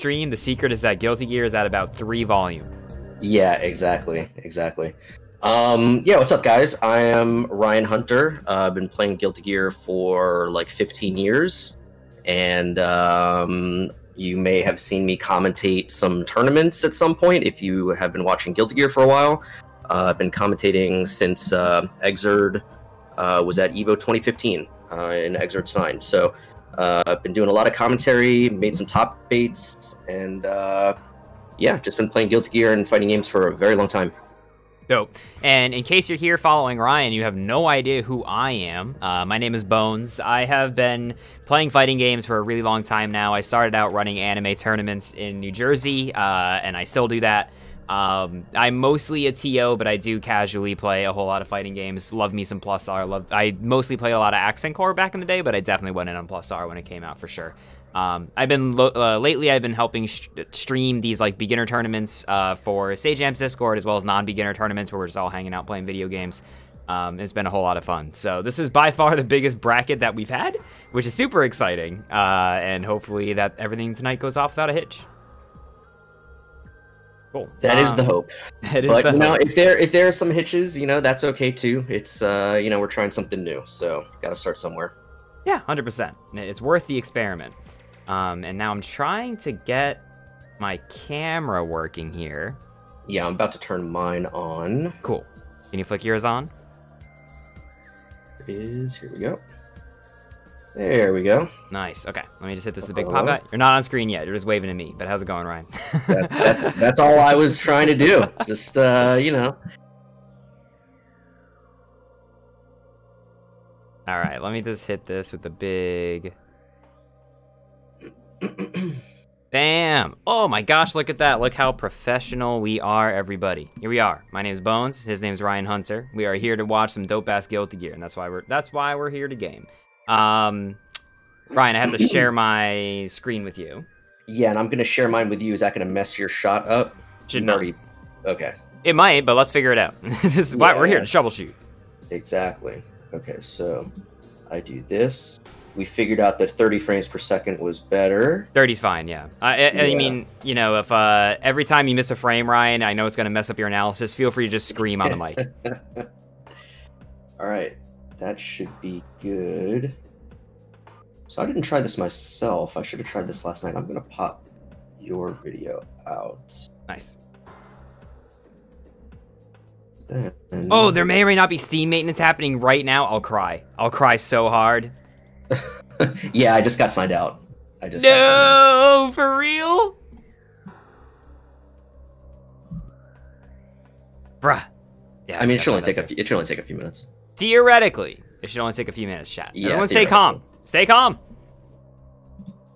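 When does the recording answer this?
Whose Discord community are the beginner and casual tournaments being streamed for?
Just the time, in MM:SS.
01:02.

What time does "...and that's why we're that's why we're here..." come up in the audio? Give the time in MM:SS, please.
02:07.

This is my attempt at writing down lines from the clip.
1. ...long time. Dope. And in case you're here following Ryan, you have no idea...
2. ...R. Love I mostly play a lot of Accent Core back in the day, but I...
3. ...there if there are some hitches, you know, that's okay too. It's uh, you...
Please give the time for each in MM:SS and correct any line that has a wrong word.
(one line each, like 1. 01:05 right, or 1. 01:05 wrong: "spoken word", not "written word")
1. 00:33 right
2. 00:52 right
3. 01:19 right.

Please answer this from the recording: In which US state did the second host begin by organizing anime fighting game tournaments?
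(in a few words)
New Jersey.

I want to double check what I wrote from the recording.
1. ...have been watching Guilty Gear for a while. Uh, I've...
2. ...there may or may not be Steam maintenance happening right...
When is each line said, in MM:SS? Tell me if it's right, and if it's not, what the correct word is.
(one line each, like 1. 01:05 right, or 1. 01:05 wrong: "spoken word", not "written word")
1. 00:17 right
2. 02:50 right.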